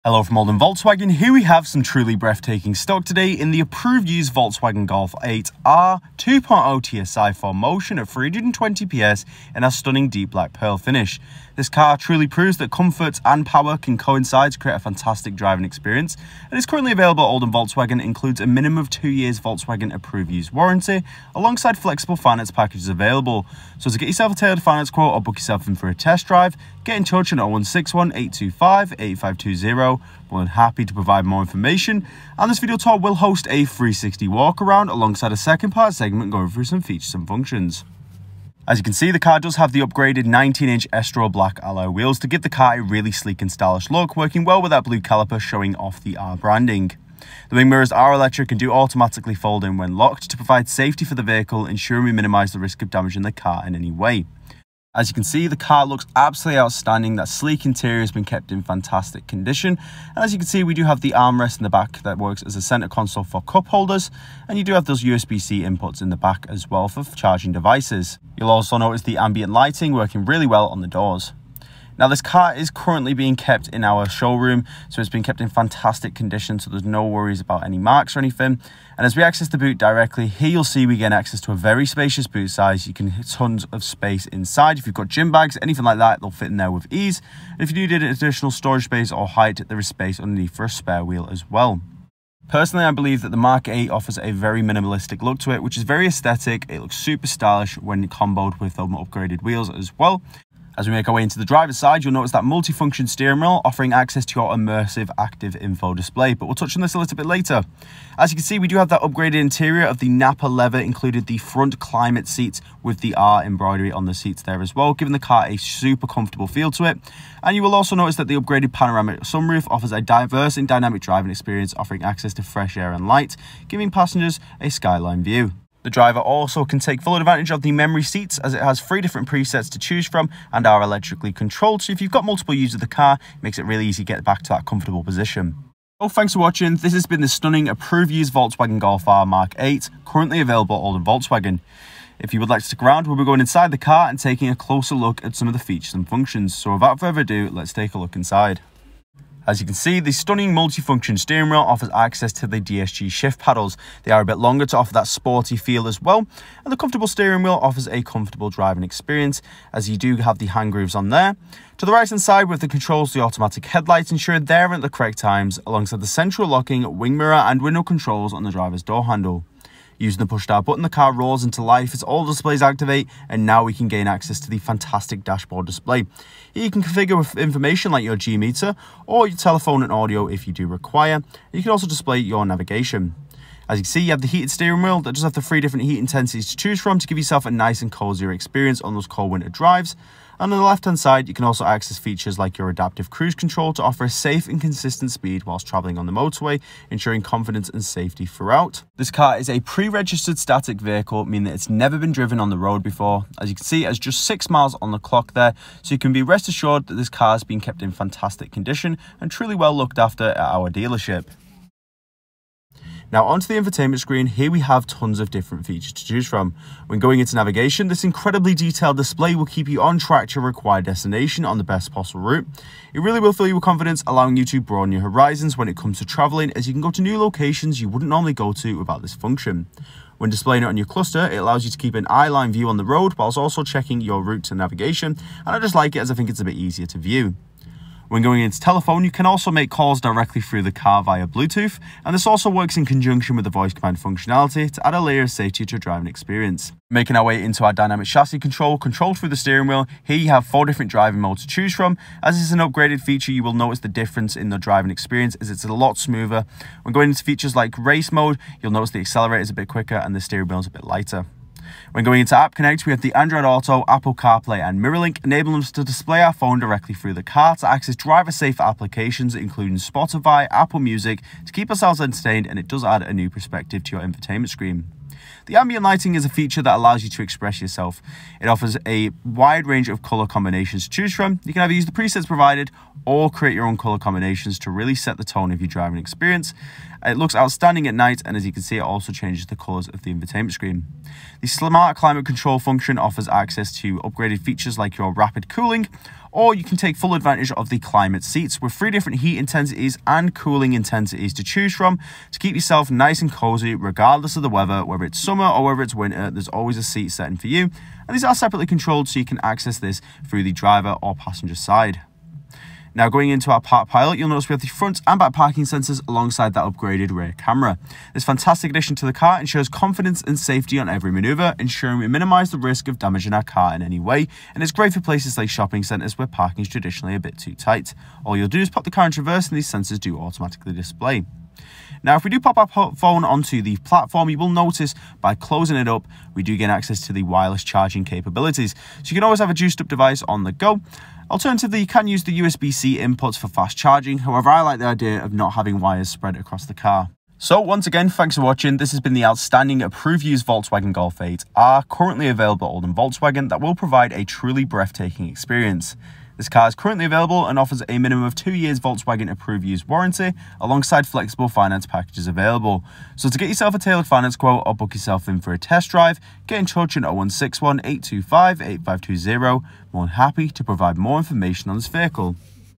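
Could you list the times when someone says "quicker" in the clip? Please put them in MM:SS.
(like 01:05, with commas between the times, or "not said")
04:19.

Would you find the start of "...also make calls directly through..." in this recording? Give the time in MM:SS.
03:59.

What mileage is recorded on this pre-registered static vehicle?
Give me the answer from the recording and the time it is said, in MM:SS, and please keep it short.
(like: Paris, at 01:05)
6, at 03:24.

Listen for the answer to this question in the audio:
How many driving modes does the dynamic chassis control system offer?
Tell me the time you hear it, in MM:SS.
04:10.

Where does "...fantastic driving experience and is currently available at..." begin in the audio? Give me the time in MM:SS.
00:14.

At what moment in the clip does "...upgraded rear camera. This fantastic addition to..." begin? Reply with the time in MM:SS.
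05:16.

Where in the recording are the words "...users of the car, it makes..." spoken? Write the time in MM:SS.
02:12.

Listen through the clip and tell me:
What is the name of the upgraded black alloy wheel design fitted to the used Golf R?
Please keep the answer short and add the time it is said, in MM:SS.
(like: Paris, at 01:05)
Estoril, at 00:40.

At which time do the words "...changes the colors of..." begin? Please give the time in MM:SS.
04:49.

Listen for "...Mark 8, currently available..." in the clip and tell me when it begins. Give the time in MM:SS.
02:19.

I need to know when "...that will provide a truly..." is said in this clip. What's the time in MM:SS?
05:53.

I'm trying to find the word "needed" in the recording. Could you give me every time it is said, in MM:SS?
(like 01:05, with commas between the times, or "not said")
01:27.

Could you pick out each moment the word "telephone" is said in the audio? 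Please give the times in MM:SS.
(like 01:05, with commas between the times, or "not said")
02:59, 03:58.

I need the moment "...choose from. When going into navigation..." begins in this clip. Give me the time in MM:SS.
03:36.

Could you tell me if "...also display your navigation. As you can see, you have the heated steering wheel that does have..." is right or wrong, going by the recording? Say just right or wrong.
right.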